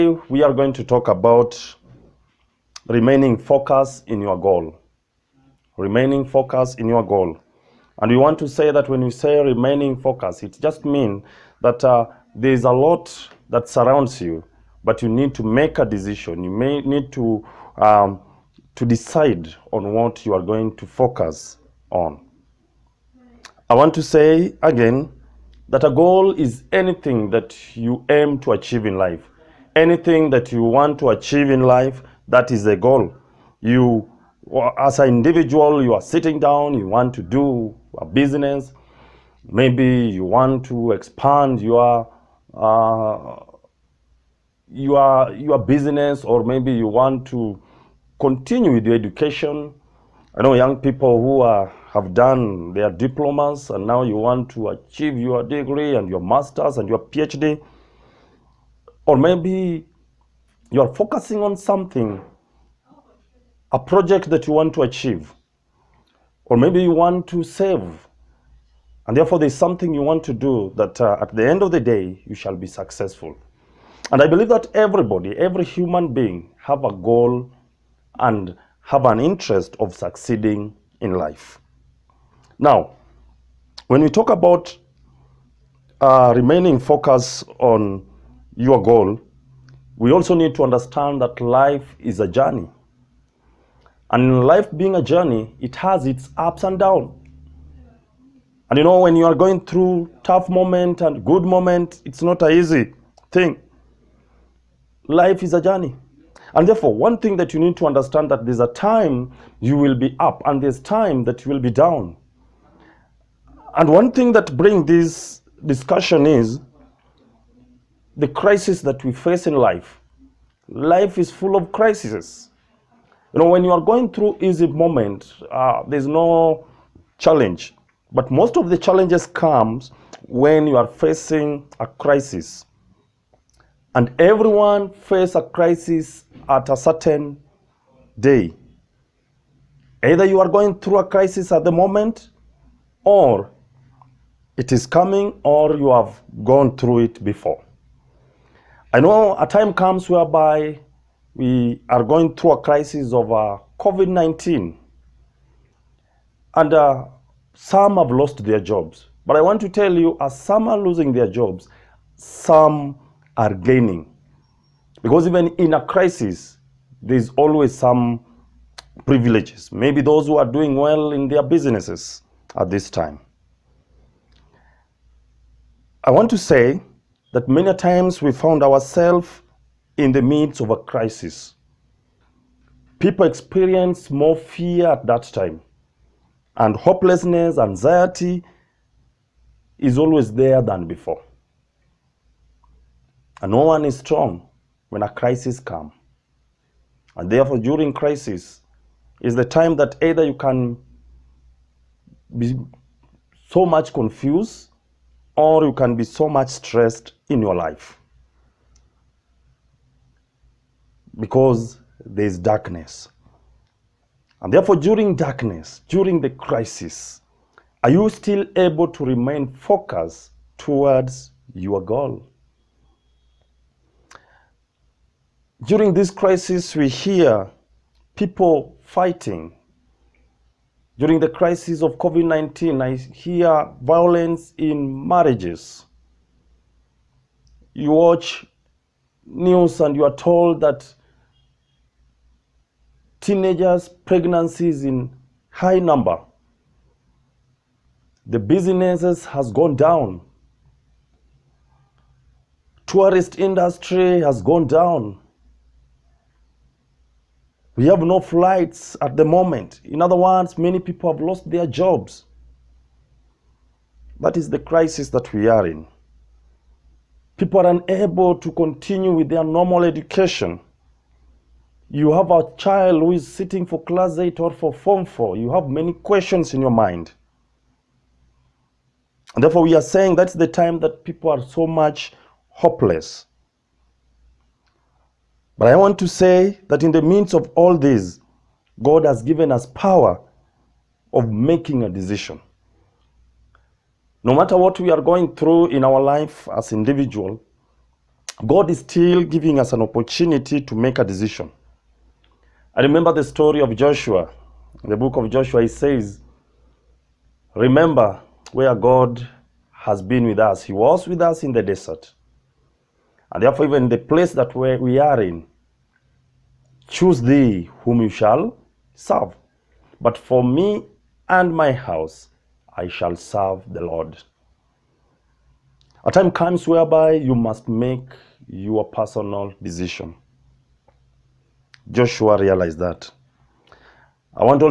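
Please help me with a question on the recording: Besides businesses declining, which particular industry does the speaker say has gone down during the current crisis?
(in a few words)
Tourist industry.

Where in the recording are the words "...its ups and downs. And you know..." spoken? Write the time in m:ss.
1:36.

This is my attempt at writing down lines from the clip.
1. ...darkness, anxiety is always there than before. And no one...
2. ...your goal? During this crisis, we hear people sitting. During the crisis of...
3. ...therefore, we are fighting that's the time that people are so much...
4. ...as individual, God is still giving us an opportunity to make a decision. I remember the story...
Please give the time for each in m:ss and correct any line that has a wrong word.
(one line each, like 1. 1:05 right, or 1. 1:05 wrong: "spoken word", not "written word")
1. 3:06 wrong: "hopelessness", not "darkness"
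2. 3:41 wrong: "fighting", not "sitting"
3. 4:39 wrong: "saying", not "fighting"
4. 4:56 right.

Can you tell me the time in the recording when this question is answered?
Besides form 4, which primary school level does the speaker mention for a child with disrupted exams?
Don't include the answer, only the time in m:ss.
4:33.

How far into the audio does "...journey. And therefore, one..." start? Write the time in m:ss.
1:45.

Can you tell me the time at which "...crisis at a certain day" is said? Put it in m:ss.
2:15.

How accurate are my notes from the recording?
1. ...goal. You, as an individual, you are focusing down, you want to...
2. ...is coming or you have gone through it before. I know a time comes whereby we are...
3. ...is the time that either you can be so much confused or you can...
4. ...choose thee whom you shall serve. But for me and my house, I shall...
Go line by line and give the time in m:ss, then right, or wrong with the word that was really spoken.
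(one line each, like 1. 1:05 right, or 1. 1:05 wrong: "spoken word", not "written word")
1. 0:32 wrong: "sitting", not "focusing"
2. 2:24 right
3. 3:19 right
4. 5:16 right.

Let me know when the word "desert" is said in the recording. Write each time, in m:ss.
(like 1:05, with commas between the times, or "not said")
5:11.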